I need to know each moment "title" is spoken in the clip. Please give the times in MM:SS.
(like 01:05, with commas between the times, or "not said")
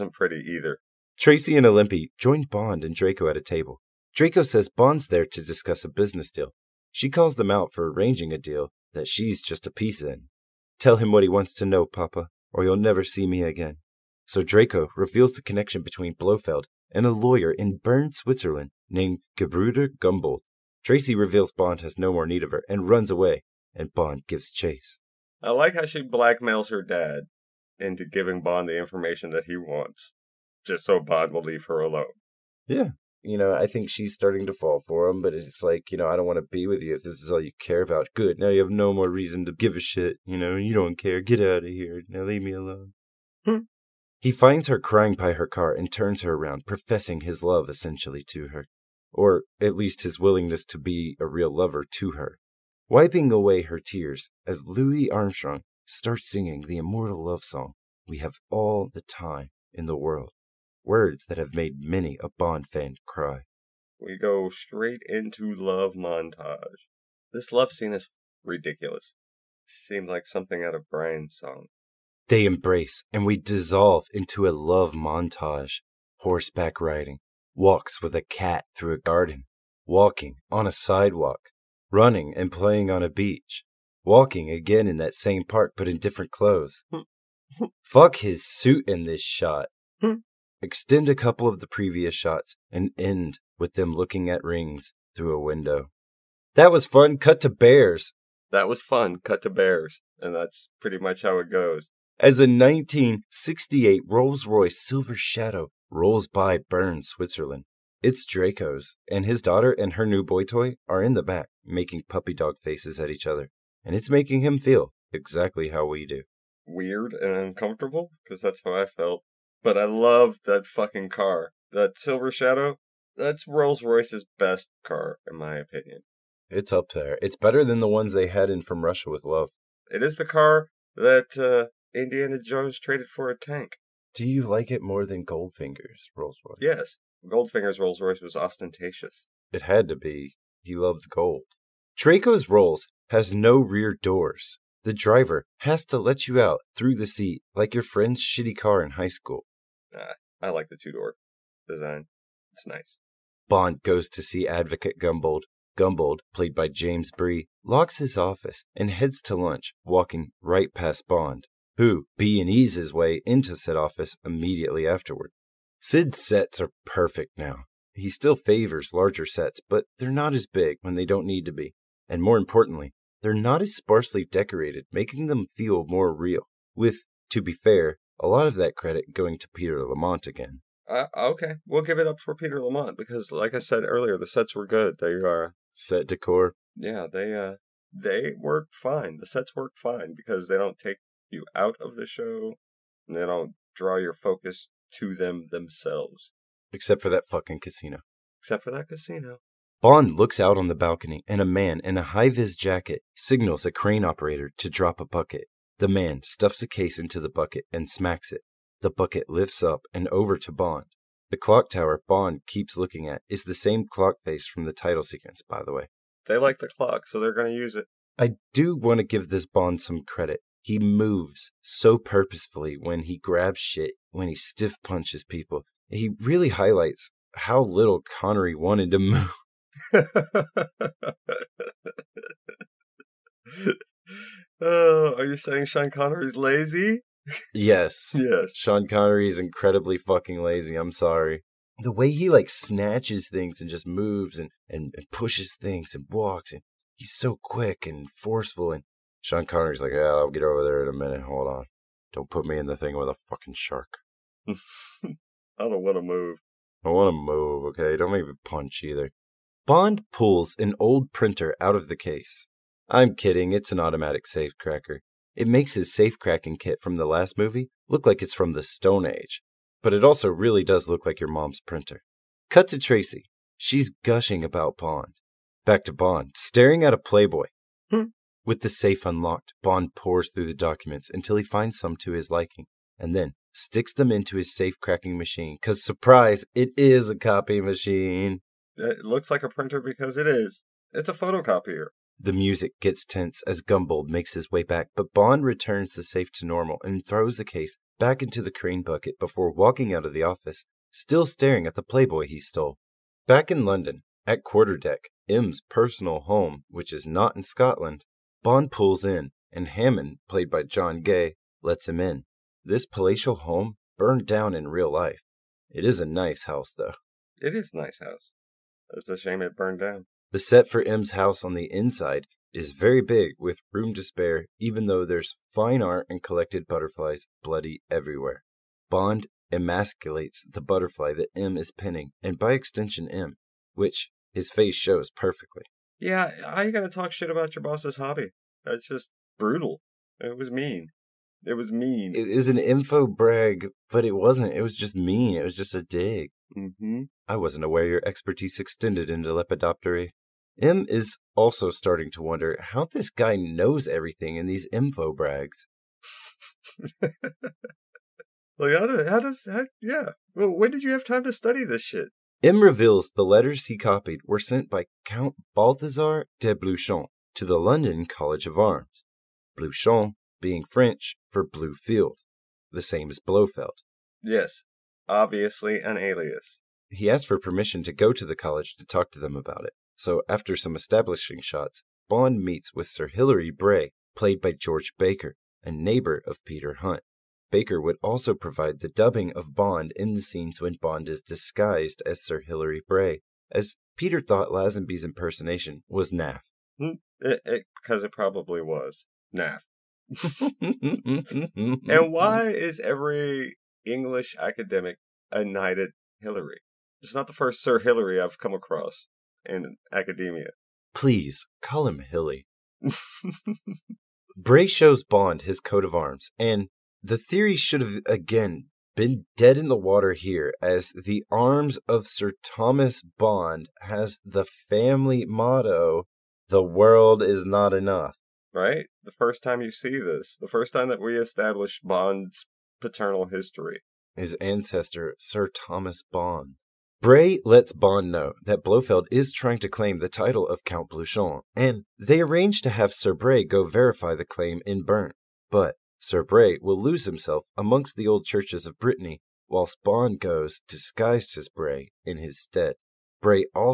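03:34, 07:20.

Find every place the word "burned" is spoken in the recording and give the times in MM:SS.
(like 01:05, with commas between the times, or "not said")
05:13, 05:19.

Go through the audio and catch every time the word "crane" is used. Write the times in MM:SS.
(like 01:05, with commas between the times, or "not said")
03:23, 04:58.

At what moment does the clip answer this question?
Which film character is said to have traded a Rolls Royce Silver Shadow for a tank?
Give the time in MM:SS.
02:11.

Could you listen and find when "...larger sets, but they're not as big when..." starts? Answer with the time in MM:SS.
02:48.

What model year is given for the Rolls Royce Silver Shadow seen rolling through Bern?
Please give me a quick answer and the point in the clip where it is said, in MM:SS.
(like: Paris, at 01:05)
1968, at 01:42.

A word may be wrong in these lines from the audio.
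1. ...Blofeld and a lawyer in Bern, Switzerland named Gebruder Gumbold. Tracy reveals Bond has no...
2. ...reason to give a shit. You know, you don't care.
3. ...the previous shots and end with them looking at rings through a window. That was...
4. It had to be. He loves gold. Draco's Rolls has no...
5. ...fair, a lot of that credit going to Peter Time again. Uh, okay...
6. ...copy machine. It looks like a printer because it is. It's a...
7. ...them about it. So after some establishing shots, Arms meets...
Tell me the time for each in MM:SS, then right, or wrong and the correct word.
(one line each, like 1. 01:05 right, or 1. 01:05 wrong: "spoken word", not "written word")
1. 00:16 right
2. 00:39 right
3. 01:31 right
4. 02:19 right
5. 02:57 wrong: "Lamont", not "Time"
6. 04:47 right
7. 06:19 wrong: "Bond", not "Arms".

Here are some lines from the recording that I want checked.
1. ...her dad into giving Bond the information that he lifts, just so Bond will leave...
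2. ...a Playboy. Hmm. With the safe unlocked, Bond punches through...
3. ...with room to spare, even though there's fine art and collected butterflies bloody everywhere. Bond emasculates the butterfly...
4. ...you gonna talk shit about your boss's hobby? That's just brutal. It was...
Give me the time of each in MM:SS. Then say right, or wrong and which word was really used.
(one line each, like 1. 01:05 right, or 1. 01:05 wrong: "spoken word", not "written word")
1. 00:26 wrong: "wants", not "lifts"
2. 04:36 wrong: "pores", not "punches"
3. 05:23 right
4. 05:36 right.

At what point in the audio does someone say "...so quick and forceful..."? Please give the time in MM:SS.
04:07.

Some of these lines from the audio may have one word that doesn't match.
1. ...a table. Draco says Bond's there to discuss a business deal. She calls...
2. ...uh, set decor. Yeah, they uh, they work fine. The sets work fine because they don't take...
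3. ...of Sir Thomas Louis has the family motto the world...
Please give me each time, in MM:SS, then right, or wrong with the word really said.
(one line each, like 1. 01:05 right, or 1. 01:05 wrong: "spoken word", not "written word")
1. 00:03 right
2. 03:05 right
3. 07:01 wrong: "Bond", not "Louis".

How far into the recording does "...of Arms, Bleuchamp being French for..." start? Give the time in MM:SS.
06:08.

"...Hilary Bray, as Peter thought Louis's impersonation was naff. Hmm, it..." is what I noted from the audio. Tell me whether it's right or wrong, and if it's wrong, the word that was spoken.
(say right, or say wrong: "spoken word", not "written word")
wrong: "Lazenby", not "Louis".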